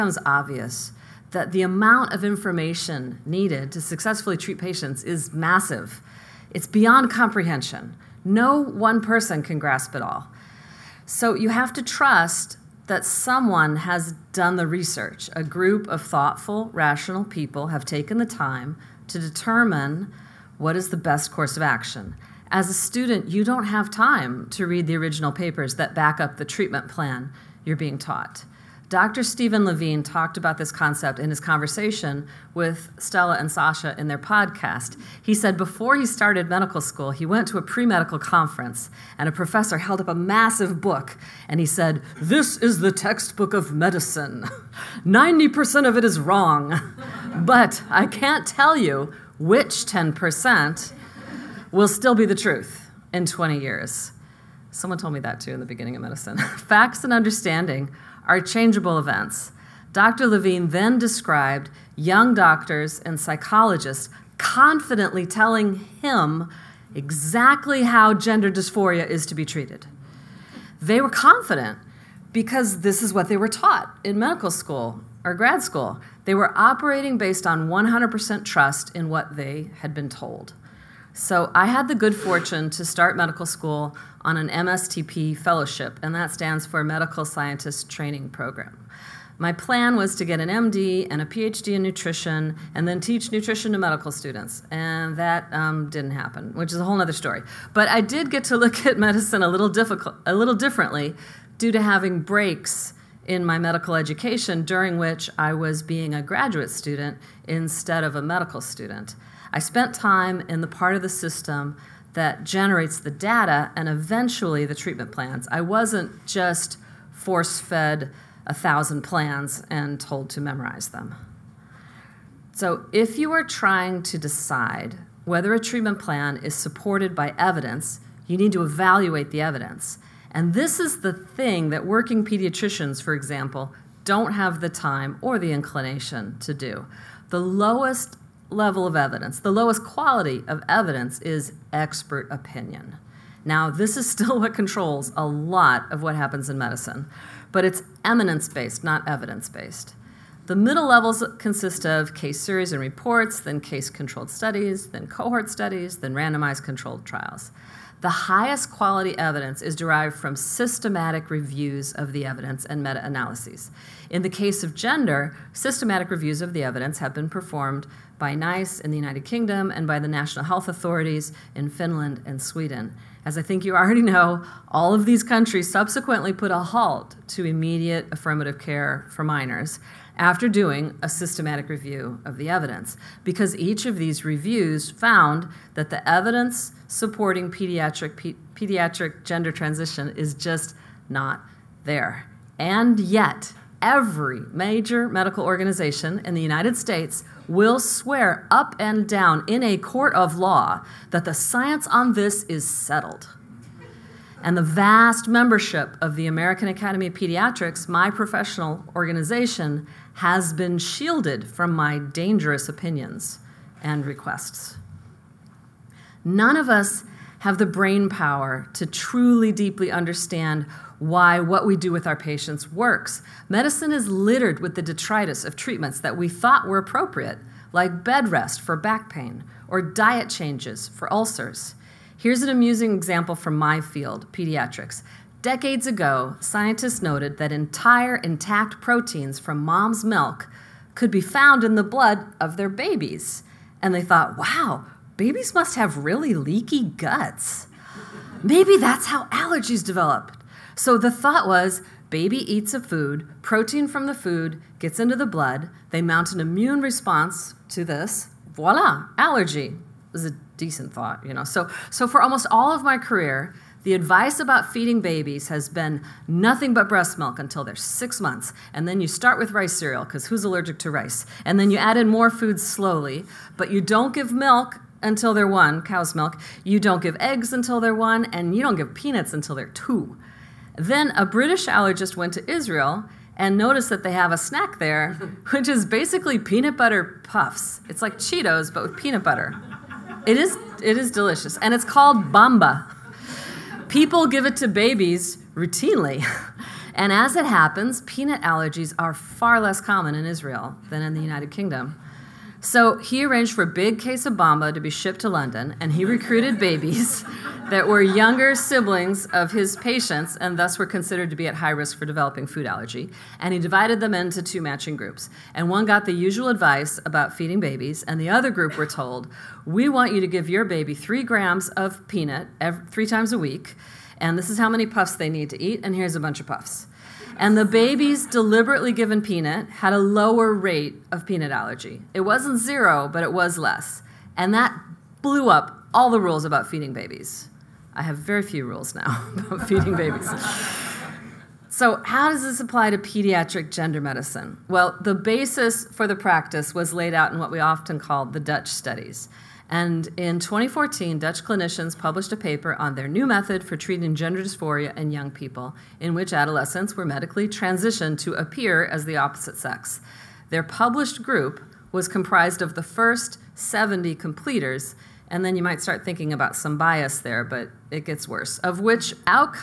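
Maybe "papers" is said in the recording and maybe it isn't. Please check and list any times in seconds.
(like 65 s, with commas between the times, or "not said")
25 s, 352 s.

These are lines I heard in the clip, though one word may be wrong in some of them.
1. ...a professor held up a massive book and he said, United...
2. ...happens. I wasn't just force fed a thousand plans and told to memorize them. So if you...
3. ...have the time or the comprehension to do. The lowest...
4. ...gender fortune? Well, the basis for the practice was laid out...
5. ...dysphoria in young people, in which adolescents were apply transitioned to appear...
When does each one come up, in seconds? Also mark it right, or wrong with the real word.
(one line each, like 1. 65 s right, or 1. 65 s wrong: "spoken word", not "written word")
1. 39 s wrong: "This", not "United"
2. 115 s wrong: "plans", not "happens"
3. 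134 s wrong: "inclination", not "comprehension"
4. 343 s wrong: "medicine", not "fortune"
5. 354 s wrong: "medically", not "apply".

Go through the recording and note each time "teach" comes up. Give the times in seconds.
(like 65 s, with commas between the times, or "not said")
92 s.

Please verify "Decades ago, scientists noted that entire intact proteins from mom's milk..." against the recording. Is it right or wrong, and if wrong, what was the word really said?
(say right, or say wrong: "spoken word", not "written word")
right.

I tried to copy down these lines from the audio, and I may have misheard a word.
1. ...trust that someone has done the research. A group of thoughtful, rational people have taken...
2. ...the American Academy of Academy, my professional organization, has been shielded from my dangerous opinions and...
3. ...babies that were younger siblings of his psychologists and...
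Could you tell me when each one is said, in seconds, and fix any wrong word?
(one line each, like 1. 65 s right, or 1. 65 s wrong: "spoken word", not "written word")
1. 11 s right
2. 206 s wrong: "Pediatrics", not "Academy"
3. 306 s wrong: "patients", not "psychologists".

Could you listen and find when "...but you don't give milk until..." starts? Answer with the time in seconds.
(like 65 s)
273 s.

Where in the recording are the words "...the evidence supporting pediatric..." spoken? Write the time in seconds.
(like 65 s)
185 s.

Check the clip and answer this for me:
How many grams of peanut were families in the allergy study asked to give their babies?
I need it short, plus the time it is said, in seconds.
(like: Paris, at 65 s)
3, at 320 s.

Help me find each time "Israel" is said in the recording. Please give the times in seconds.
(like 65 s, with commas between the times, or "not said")
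282 s, 300 s.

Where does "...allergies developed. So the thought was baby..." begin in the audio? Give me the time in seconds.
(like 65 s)
249 s.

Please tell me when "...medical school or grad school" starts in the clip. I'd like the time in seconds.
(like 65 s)
74 s.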